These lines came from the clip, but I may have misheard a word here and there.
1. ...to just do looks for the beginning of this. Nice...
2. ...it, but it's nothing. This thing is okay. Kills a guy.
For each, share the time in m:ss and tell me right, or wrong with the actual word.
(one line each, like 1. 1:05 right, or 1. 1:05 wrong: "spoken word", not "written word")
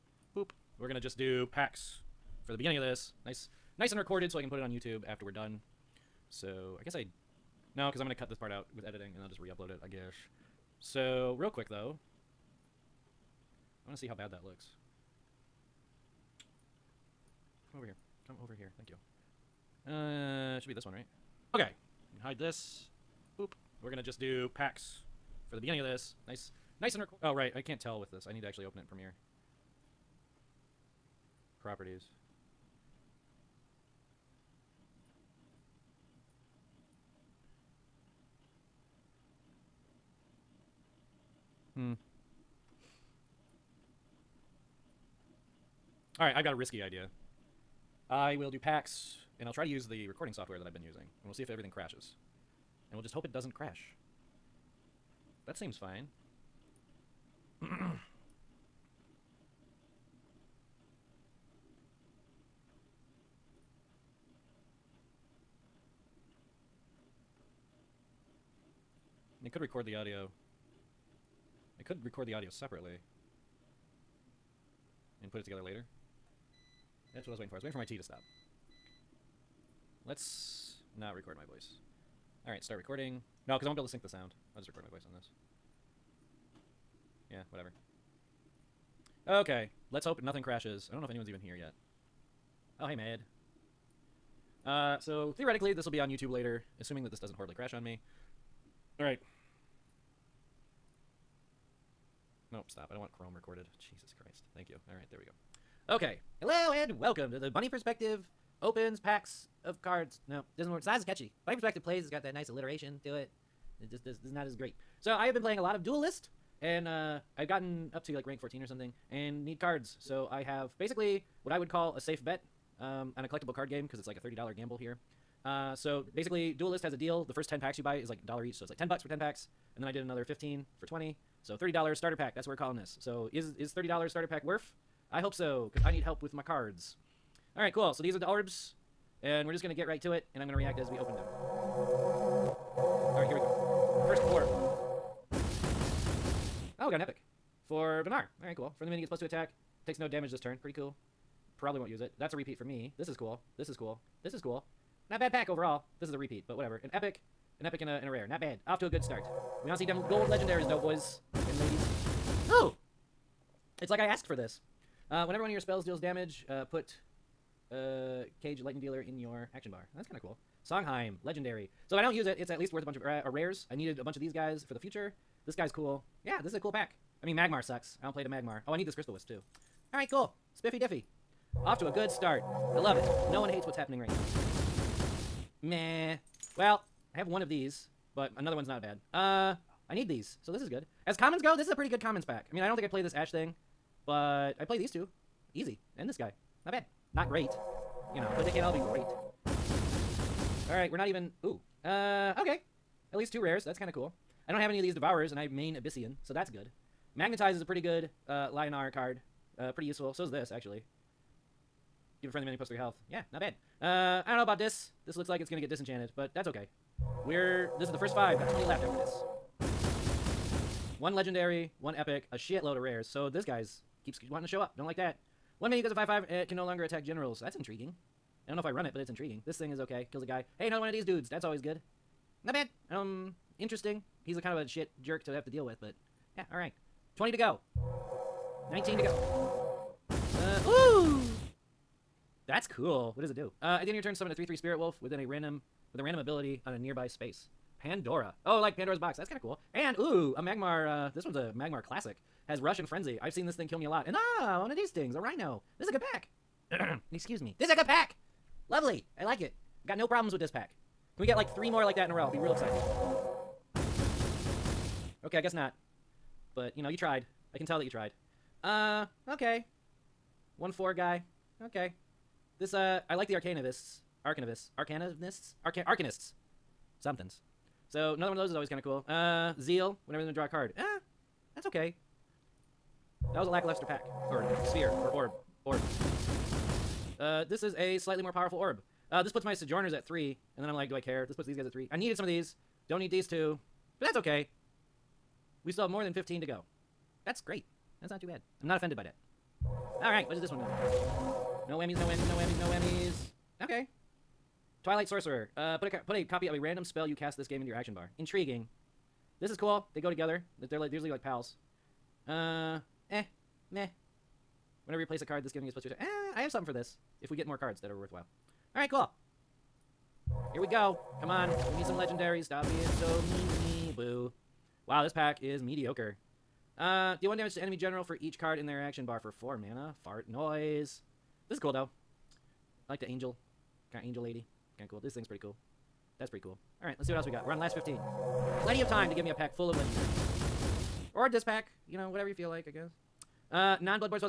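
1. 0:00 wrong: "packs", not "looks"
2. 3:48 wrong: "intriguing", not "nothing".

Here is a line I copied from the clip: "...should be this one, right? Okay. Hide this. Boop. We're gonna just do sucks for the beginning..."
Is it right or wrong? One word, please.
wrong.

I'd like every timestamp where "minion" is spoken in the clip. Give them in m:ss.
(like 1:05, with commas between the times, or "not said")
2:28, 3:32.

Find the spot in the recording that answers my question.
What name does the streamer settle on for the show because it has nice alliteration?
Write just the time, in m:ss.
1:51.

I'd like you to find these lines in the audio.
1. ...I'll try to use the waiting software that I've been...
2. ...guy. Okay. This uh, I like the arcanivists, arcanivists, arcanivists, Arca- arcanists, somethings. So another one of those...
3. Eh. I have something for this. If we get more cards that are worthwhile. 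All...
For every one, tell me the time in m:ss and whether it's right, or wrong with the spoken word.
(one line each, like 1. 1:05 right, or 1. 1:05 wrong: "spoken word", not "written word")
1. 0:49 wrong: "recording", not "waiting"
2. 4:30 right
3. 5:15 right.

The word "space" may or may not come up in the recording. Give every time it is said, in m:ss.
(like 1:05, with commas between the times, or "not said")
4:07.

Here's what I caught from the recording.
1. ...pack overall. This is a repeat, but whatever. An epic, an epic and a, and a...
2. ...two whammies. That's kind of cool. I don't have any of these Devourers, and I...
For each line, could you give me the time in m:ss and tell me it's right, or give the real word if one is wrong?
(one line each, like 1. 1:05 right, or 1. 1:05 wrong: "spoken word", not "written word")
1. 2:35 right
2. 3:23 wrong: "rares", not "whammies".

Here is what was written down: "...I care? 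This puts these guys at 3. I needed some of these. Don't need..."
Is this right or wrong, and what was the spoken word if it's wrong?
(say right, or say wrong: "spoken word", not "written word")
right.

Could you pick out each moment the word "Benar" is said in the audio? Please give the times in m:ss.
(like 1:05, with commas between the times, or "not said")
2:28.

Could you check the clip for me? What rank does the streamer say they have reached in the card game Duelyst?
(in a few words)
14.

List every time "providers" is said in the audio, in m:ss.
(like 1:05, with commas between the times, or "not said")
not said.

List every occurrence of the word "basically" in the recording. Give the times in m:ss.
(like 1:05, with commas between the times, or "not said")
2:00, 2:06.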